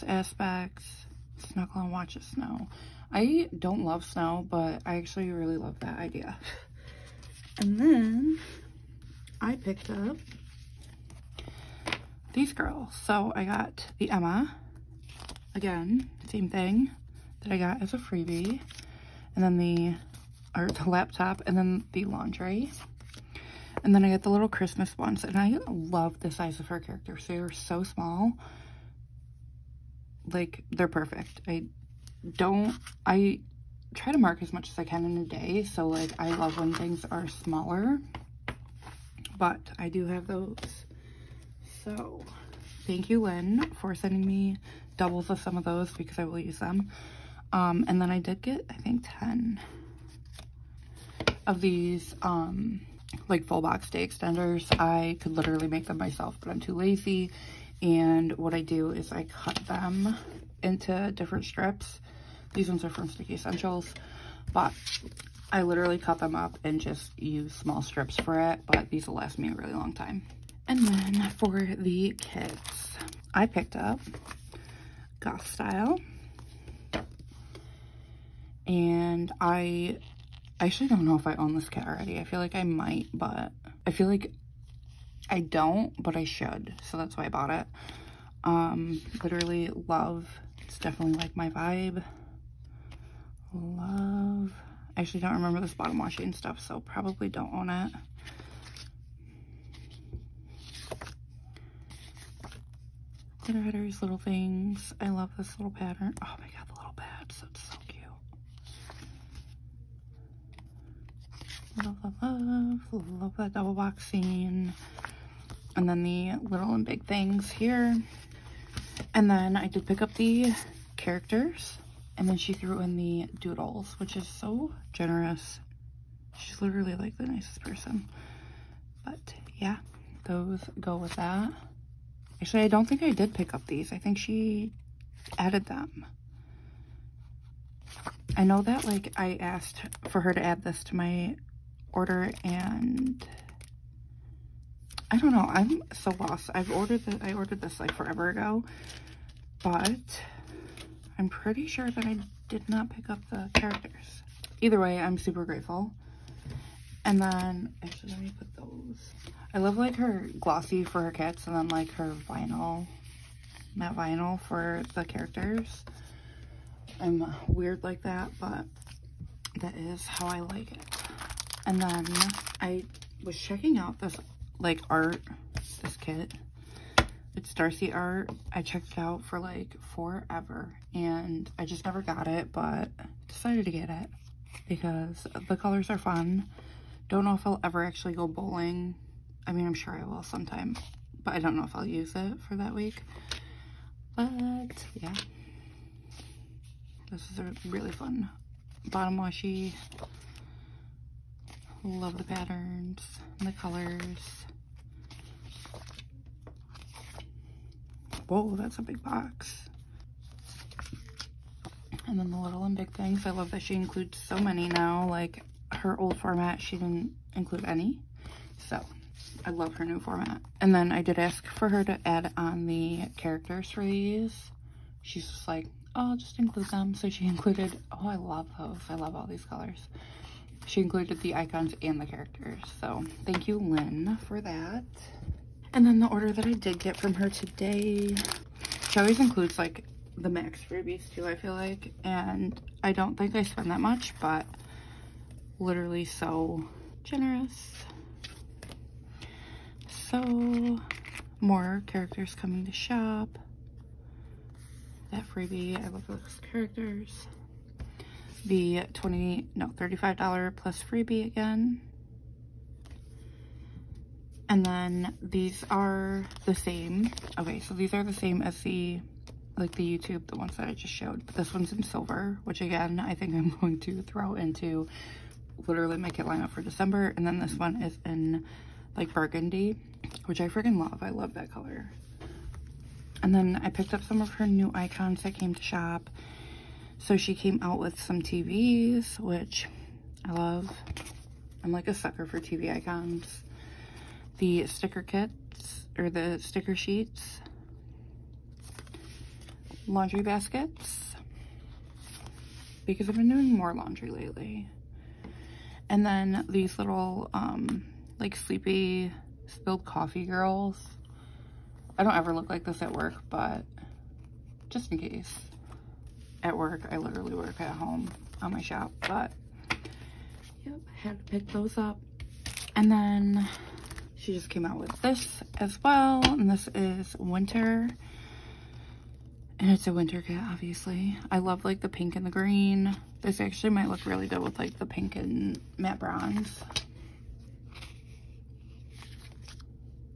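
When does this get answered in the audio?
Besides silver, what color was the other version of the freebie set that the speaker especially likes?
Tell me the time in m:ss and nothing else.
4:39.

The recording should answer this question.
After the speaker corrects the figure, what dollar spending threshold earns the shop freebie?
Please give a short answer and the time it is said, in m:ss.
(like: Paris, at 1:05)
$35, at 4:19.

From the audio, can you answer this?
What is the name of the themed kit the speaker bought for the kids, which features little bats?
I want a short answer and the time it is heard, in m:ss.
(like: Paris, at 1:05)
Goth Style, at 1:15.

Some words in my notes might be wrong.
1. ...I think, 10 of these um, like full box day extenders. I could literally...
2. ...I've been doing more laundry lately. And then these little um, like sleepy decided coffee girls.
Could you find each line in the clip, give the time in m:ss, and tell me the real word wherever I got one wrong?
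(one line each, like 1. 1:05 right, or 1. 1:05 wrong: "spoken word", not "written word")
1. 0:48 right
2. 5:03 wrong: "spilled", not "decided".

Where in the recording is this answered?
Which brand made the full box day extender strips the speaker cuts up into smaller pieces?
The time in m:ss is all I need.
1:03.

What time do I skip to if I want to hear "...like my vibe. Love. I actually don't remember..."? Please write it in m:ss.
1:31.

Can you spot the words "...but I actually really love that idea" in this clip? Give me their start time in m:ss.
0:04.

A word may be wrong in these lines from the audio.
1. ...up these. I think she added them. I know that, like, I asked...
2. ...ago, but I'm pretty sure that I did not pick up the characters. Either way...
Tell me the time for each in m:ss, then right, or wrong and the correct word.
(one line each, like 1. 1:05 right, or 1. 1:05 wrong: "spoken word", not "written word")
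1. 2:13 right
2. 2:28 right.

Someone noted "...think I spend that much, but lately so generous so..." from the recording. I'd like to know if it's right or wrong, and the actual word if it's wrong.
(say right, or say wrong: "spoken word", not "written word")
wrong: "literally", not "lately".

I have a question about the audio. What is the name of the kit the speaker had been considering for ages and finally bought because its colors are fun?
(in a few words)
Darcy art.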